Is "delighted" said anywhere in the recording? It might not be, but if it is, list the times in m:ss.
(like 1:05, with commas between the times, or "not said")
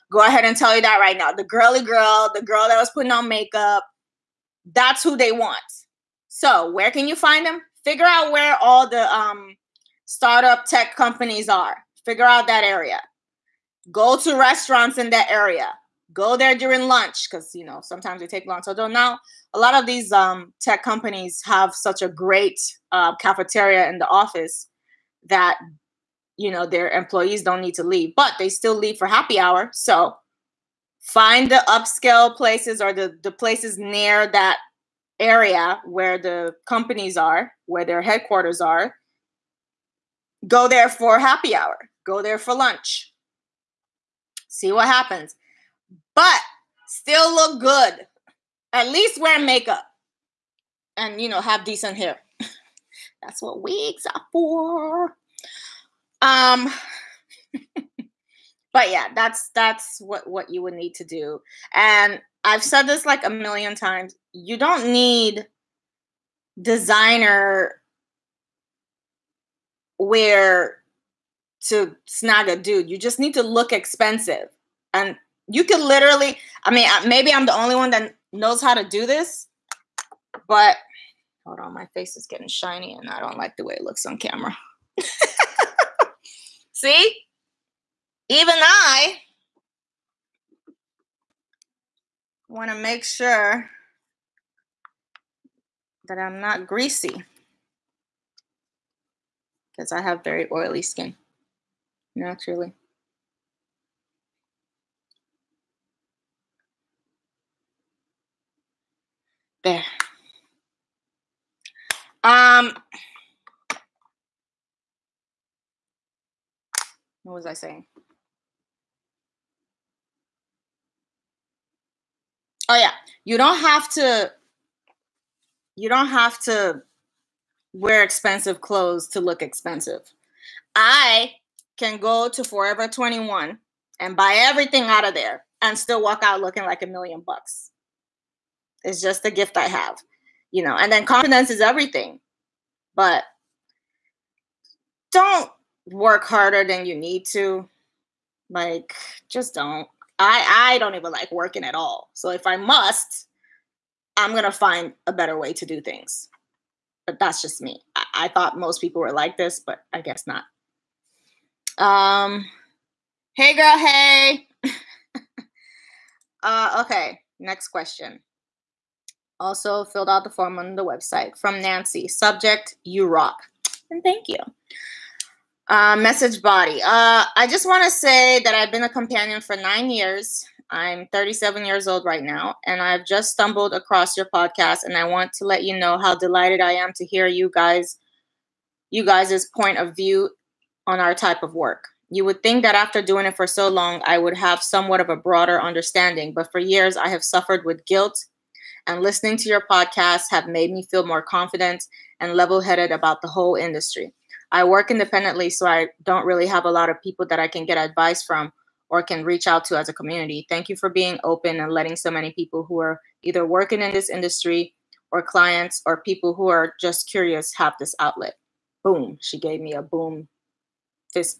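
3:06.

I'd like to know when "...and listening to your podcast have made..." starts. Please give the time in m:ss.
3:18.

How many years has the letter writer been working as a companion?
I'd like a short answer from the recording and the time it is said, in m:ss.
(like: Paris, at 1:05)
9, at 2:59.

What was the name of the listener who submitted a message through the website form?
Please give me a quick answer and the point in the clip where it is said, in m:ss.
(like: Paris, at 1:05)
Nancy, at 2:51.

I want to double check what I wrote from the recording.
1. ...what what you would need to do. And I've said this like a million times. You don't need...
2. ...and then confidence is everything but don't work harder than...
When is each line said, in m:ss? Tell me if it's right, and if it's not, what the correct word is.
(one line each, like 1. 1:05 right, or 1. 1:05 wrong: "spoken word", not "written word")
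1. 0:59 right
2. 2:20 right.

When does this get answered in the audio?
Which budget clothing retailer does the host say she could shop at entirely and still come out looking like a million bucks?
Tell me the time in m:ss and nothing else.
2:12.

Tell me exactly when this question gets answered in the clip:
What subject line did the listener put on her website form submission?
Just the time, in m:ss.
2:52.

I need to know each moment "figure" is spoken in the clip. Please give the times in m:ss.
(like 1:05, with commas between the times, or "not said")
0:07, 0:12.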